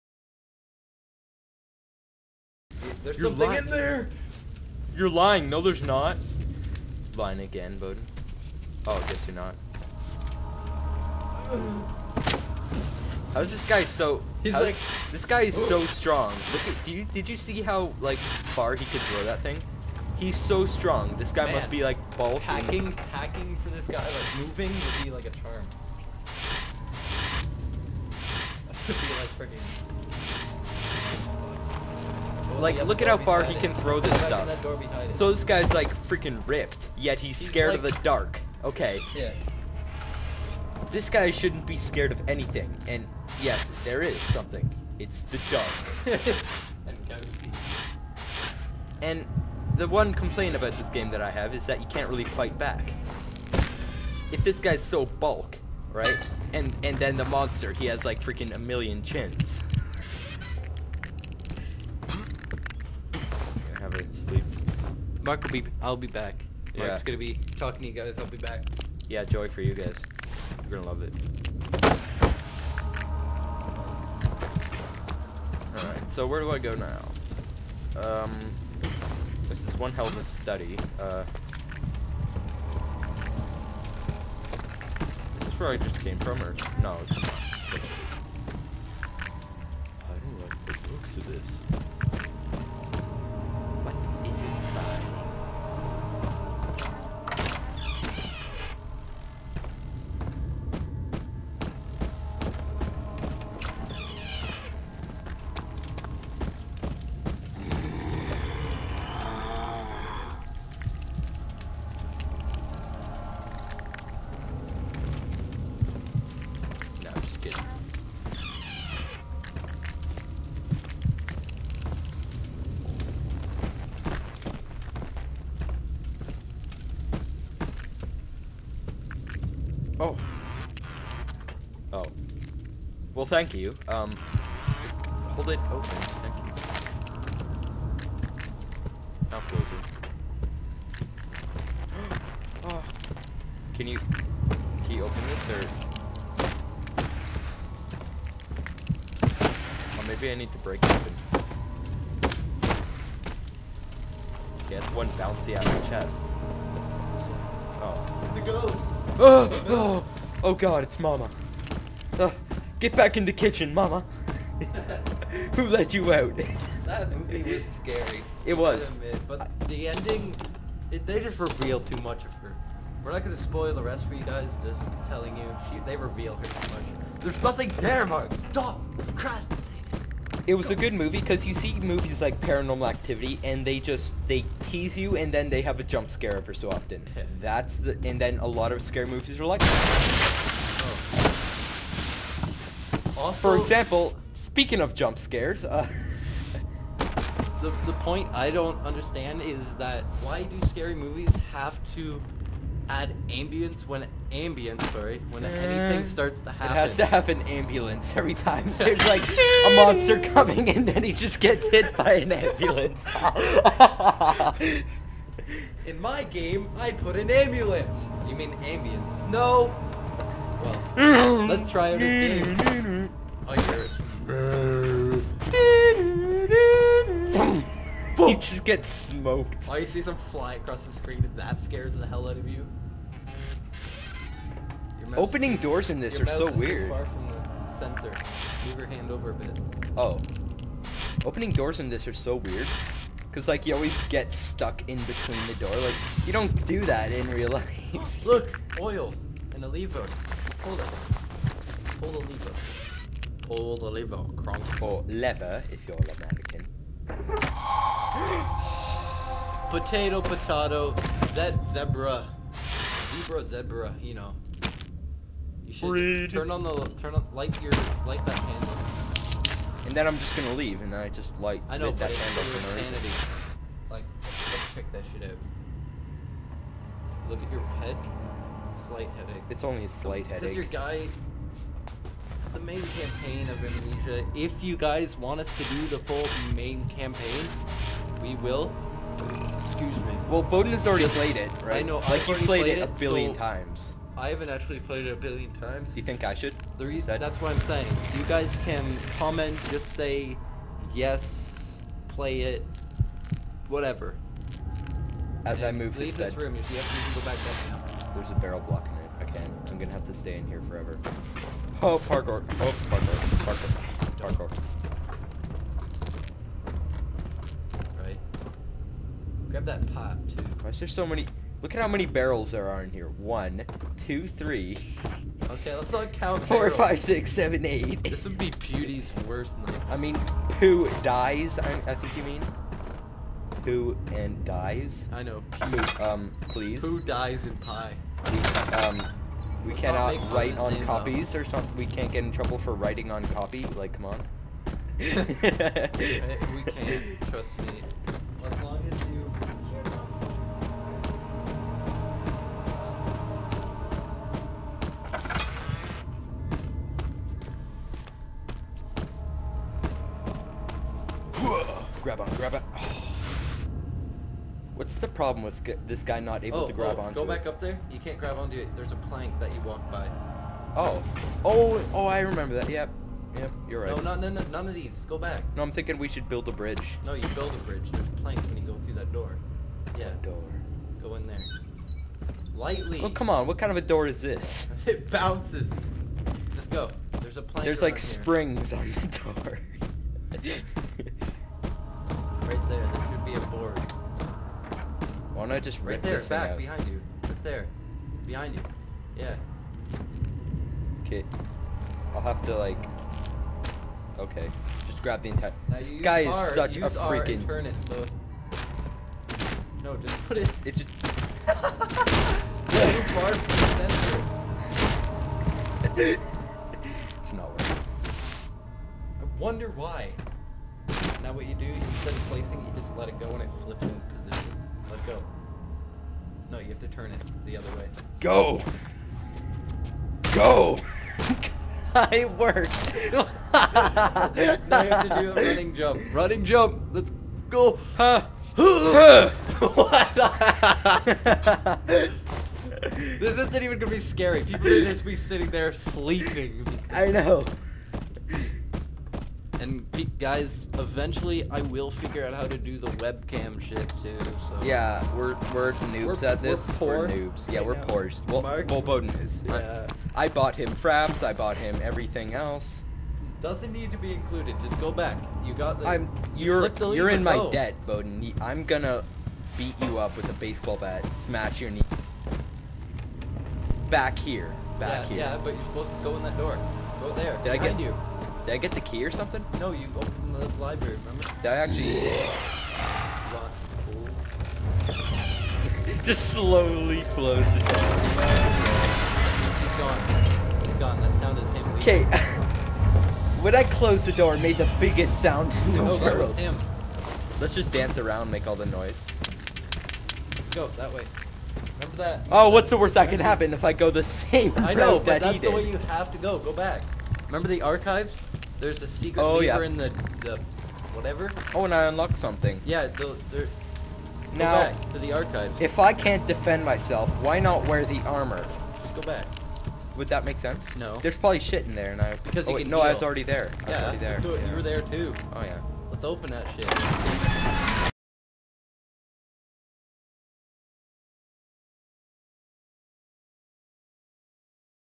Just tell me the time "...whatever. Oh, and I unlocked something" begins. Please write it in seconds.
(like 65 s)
510 s.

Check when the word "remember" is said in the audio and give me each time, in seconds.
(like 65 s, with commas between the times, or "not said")
372 s, 481 s, 501 s, 507 s.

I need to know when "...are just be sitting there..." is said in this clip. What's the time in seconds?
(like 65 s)
444 s.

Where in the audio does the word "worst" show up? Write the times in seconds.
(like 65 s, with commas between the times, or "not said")
329 s, 502 s.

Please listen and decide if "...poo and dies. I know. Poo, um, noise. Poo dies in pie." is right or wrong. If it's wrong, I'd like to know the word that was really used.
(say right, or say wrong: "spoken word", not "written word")
wrong: "please", not "noise".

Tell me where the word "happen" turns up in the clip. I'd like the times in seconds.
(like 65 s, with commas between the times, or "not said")
206 s, 503 s.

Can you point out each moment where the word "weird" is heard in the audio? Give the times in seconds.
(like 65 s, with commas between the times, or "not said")
236 s, 242 s.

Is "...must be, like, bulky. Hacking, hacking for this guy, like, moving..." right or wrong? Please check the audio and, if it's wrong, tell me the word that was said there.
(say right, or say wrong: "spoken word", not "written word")
right.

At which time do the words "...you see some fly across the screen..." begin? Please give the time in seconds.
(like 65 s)
229 s.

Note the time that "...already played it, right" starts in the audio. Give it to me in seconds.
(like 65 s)
290 s.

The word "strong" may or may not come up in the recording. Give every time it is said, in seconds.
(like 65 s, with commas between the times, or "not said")
15 s, 20 s.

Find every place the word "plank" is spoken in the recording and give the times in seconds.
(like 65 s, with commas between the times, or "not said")
368 s, 378 s, 387 s.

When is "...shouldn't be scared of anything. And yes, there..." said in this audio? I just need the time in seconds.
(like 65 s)
41 s.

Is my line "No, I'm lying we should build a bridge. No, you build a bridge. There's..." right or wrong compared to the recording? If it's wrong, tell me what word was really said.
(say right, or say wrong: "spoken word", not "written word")
wrong: "thinking", not "lying".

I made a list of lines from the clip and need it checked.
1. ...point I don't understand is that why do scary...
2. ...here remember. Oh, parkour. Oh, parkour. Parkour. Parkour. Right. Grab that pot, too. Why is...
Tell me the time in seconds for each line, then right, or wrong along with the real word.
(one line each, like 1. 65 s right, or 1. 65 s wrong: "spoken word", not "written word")
1. 197 s right
2. 310 s wrong: "forever", not "remember".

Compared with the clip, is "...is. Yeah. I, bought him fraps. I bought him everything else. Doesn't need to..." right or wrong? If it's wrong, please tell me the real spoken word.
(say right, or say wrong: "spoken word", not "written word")
right.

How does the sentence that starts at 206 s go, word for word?
It has to have an ambulance every time.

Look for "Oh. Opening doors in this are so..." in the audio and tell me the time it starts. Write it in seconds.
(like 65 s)
239 s.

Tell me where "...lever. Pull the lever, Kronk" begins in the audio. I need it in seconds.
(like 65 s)
252 s.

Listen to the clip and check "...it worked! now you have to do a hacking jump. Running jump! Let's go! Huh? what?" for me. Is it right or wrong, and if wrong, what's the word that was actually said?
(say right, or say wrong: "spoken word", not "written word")
wrong: "running", not "hacking".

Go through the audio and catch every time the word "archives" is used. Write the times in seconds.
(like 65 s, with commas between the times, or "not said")
507 s, 515 s.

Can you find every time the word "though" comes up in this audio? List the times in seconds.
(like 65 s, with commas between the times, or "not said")
341 s.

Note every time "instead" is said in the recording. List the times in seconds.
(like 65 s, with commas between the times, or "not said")
421 s.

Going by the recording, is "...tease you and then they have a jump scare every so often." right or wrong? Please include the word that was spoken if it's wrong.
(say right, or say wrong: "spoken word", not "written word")
right.